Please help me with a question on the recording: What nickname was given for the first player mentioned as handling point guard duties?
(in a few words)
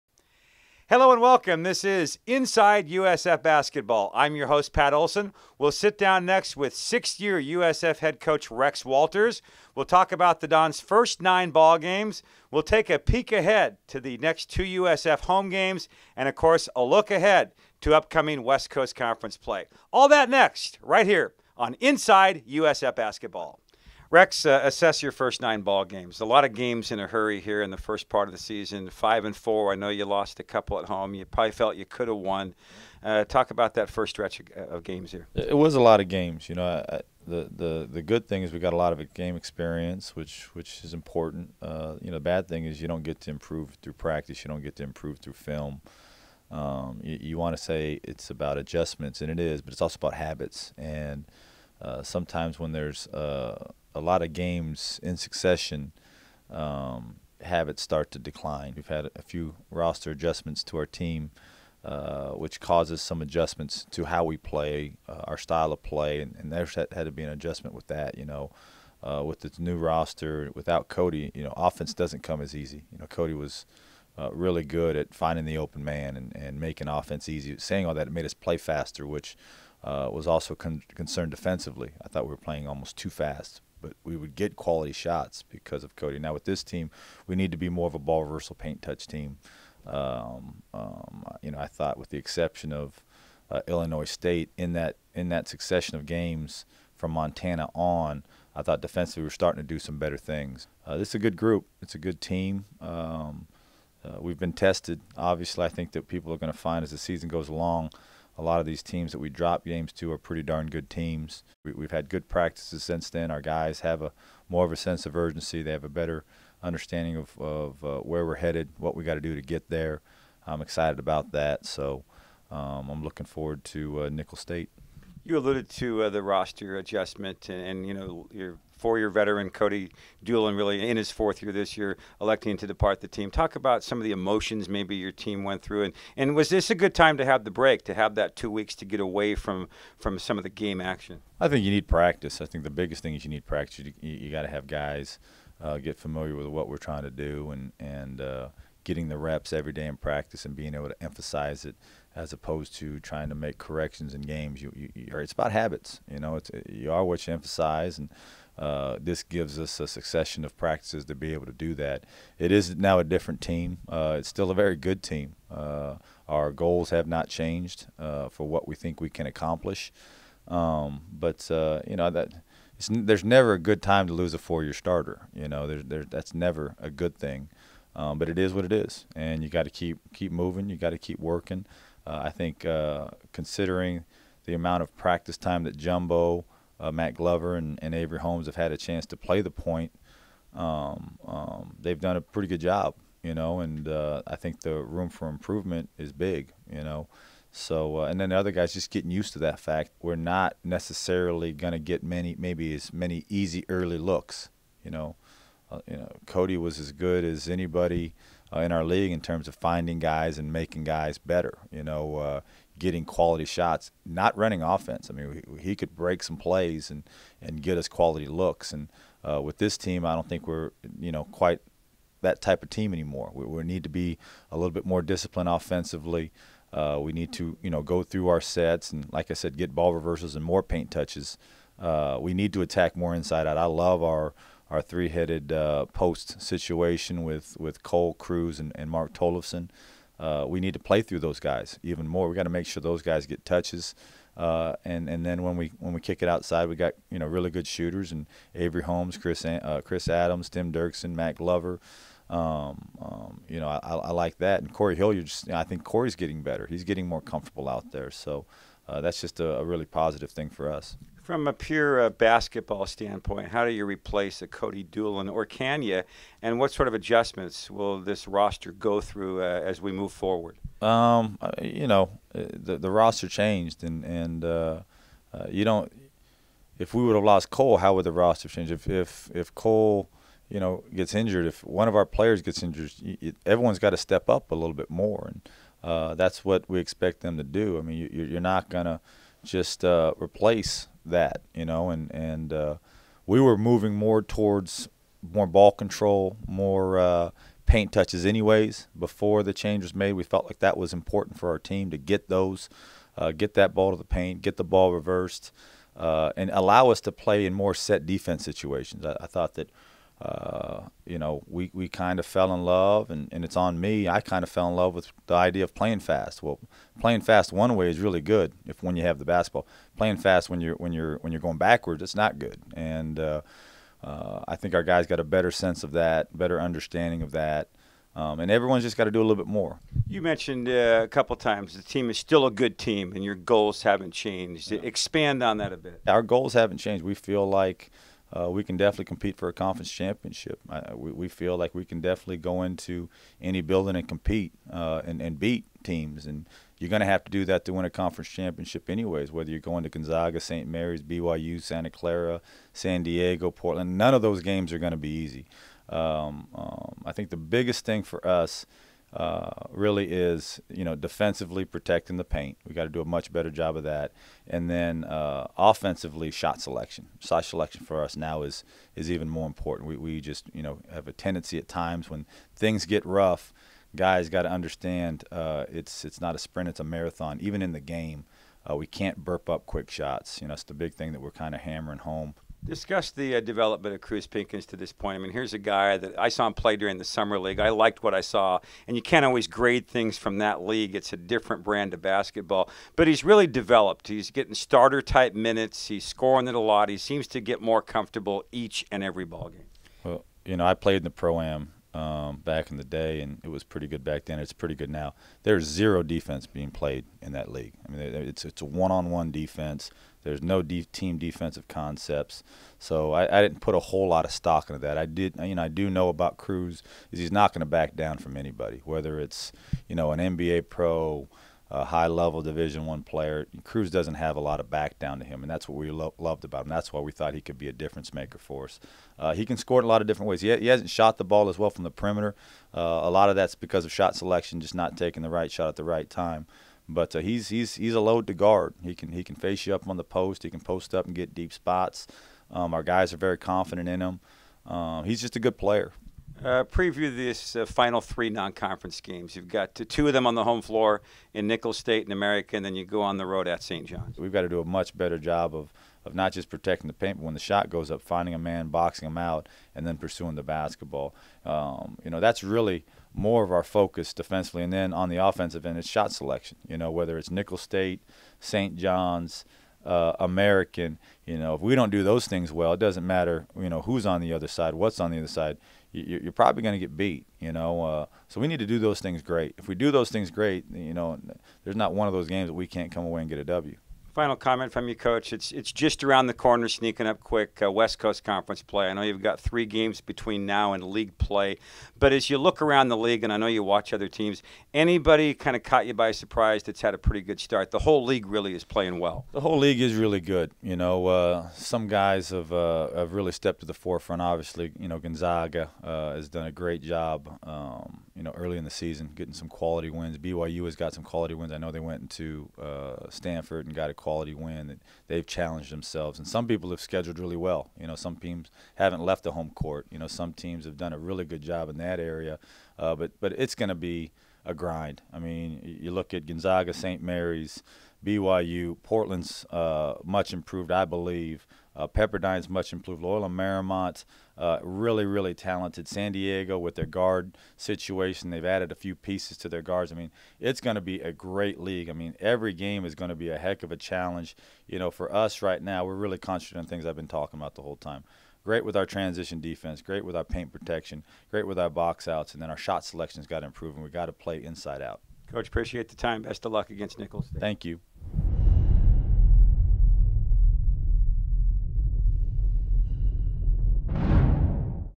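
Jumbo.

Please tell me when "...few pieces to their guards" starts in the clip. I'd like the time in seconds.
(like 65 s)
538 s.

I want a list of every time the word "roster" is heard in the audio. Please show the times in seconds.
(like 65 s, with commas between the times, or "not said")
59 s, 69 s, 126 s, 268 s, 272 s, 278 s.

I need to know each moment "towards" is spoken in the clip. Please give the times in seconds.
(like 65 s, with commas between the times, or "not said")
294 s.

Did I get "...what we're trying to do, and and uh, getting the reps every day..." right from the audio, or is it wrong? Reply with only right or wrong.
right.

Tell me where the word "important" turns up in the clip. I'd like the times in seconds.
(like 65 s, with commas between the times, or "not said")
40 s, 300 s, 369 s.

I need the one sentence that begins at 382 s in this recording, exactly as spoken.
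Discuss the uh, development of Cruz Pinkins to this point.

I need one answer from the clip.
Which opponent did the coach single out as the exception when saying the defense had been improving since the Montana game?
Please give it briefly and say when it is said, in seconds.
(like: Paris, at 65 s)
Illinois State, at 93 s.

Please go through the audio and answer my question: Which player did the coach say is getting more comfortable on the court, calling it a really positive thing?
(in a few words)
Corey Hilliard.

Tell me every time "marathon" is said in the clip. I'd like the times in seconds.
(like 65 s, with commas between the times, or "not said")
376 s.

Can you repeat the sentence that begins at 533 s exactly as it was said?
Loyola Marymount, uh, really, really talented.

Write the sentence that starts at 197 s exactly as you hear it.
So, uh, and then the other guys just getting used to that fact.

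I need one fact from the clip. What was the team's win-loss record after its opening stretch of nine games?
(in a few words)
5-4.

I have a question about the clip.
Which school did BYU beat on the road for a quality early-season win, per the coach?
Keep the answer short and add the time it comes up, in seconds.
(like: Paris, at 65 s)
Stanford, at 513 s.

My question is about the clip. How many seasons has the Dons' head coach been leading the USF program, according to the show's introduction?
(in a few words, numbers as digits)
6.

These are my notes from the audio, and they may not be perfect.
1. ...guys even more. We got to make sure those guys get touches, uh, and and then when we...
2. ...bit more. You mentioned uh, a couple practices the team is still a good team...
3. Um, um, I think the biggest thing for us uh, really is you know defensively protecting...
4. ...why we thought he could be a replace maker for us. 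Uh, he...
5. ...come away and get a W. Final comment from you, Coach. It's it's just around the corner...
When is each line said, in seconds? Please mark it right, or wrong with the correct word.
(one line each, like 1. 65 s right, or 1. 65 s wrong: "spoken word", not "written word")
1. 241 s right
2. 329 s wrong: "times", not "practices"
3. 355 s right
4. 426 s wrong: "difference", not "replace"
5. 482 s right.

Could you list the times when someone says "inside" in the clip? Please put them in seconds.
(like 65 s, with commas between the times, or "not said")
2 s, 21 s, 233 s, 554 s.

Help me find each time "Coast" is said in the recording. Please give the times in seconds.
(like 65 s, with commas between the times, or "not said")
18 s, 487 s.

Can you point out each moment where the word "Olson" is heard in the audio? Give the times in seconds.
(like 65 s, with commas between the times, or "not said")
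4 s.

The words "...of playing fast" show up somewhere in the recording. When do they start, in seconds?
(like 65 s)
315 s.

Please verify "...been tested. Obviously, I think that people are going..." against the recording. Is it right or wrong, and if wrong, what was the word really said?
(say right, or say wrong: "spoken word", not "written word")
right.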